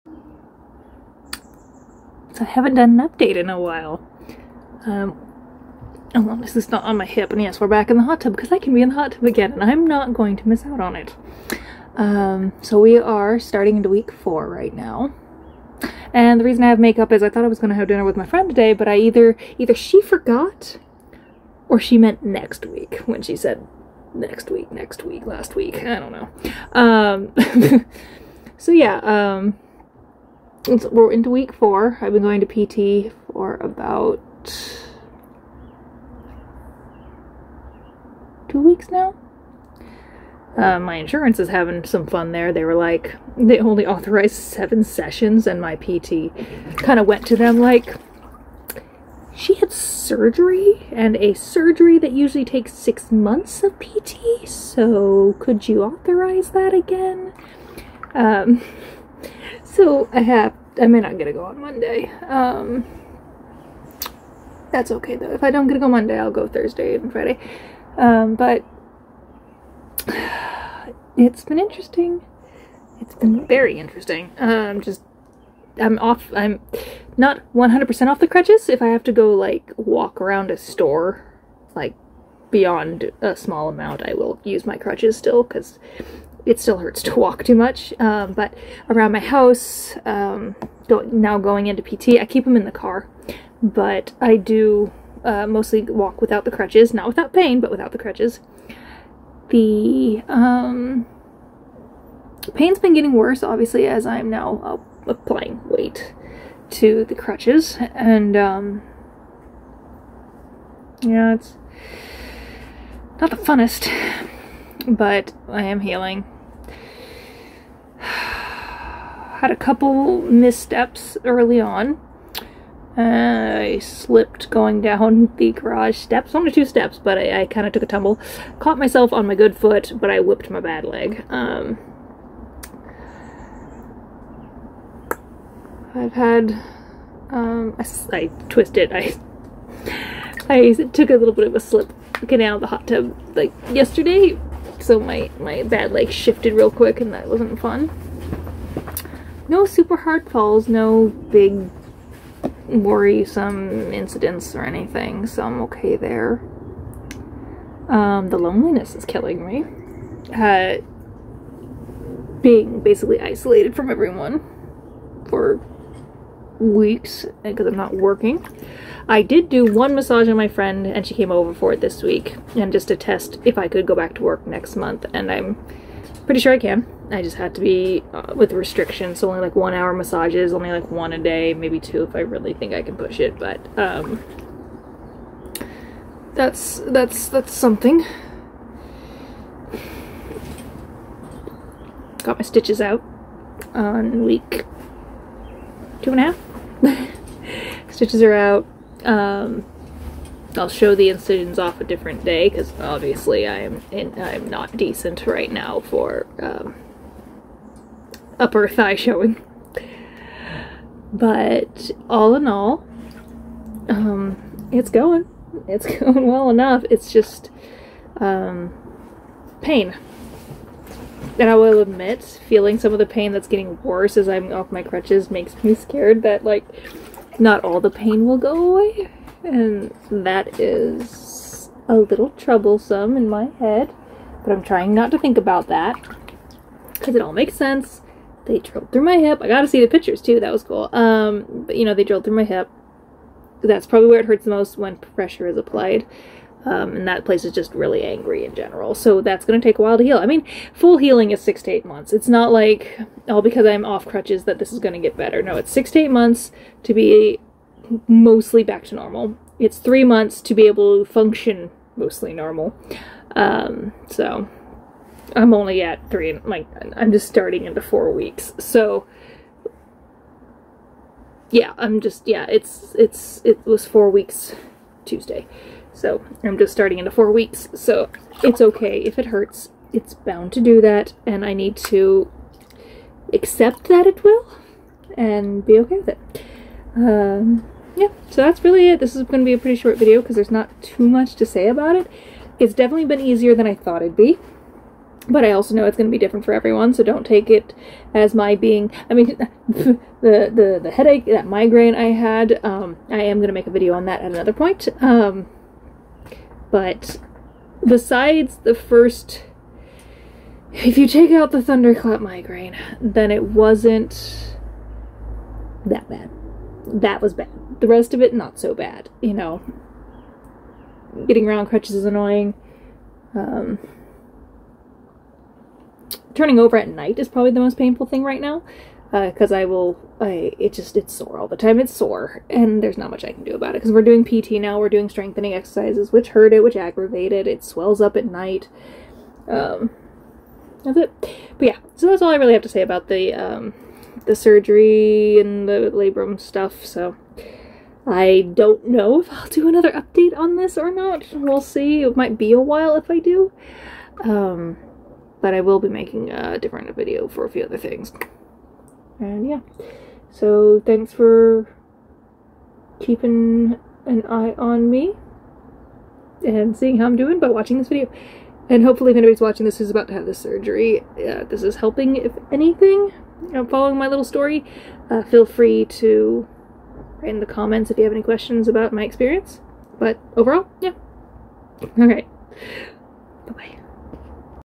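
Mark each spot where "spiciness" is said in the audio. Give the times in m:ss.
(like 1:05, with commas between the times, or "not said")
not said.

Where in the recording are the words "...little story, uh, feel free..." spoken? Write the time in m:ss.
6:14.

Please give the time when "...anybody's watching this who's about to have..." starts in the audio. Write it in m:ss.
6:09.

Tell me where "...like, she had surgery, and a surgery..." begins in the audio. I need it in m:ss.
0:47.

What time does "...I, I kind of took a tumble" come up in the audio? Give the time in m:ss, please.
2:07.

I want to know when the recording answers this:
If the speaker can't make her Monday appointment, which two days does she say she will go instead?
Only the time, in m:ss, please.
1:06.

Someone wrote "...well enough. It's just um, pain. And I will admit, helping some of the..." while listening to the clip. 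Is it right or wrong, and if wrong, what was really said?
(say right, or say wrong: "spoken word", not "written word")
wrong: "feeling", not "helping".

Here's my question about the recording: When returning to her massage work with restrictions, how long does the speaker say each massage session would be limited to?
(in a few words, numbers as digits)
1 hour.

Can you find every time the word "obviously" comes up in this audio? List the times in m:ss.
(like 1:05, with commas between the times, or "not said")
1:43, 3:22.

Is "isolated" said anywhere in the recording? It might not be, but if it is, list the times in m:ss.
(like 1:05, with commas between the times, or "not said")
2:43.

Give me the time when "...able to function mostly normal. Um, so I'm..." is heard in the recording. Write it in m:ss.
4:20.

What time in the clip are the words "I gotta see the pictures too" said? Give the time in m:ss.
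3:59.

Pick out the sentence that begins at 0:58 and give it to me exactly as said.
Um, so I have, I may not get to go on Monday.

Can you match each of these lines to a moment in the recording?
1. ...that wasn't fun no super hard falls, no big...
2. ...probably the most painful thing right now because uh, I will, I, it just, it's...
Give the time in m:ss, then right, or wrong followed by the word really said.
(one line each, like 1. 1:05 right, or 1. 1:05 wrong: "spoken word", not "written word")
1. 2:27 right
2. 5:27 right.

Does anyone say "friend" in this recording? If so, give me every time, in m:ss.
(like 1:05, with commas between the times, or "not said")
0:18, 2:50.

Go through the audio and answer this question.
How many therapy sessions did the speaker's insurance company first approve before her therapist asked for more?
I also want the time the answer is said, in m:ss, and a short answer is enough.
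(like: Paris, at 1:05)
7, at 0:44.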